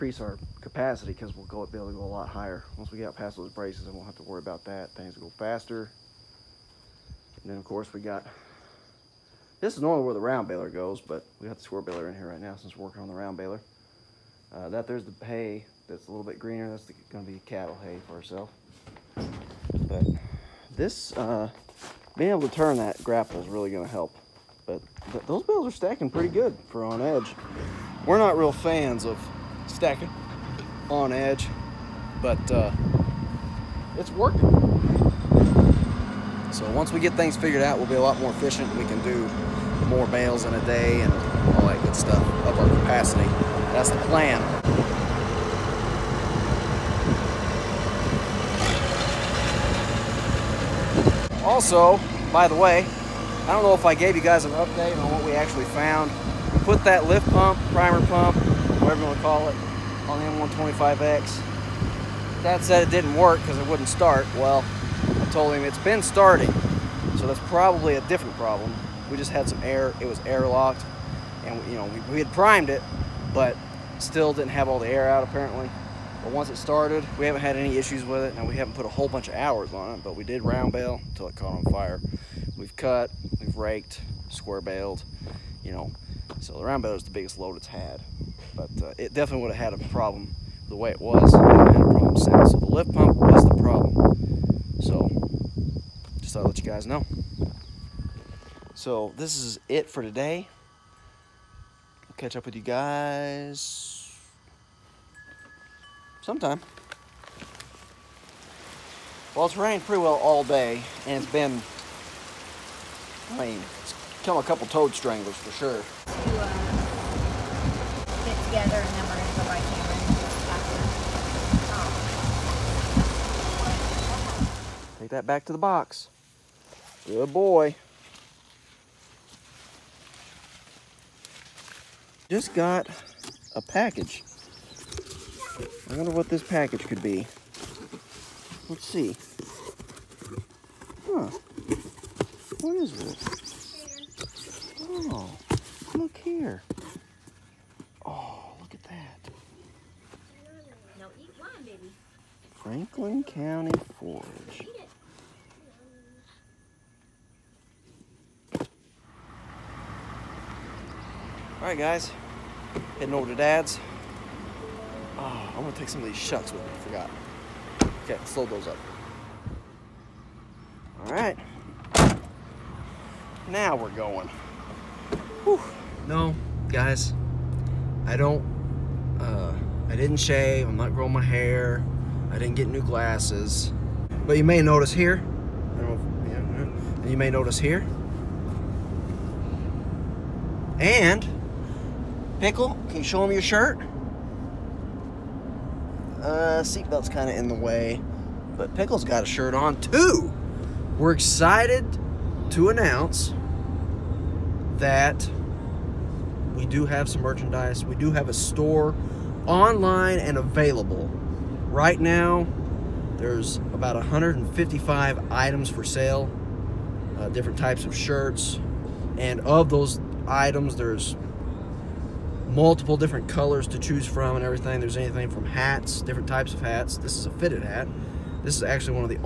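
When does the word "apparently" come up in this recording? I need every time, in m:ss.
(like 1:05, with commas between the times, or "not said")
1:15.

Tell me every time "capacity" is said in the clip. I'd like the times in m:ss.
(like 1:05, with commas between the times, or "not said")
0:00, 0:42.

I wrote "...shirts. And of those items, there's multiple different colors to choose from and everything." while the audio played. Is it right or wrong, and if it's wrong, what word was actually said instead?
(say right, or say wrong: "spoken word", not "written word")
right.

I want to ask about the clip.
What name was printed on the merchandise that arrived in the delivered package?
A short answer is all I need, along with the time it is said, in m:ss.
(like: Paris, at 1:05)
Franklin County Forage, at 2:32.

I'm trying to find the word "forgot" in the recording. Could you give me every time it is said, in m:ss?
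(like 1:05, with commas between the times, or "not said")
2:46.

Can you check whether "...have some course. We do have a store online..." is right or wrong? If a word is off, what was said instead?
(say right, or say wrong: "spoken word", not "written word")
wrong: "merchandise", not "course".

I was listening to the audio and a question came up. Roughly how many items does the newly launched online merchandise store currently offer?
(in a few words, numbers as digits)
155.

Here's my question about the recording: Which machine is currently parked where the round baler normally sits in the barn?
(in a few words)
square baler.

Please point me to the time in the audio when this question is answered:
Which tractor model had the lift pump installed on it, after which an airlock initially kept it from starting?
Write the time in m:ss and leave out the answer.
1:00.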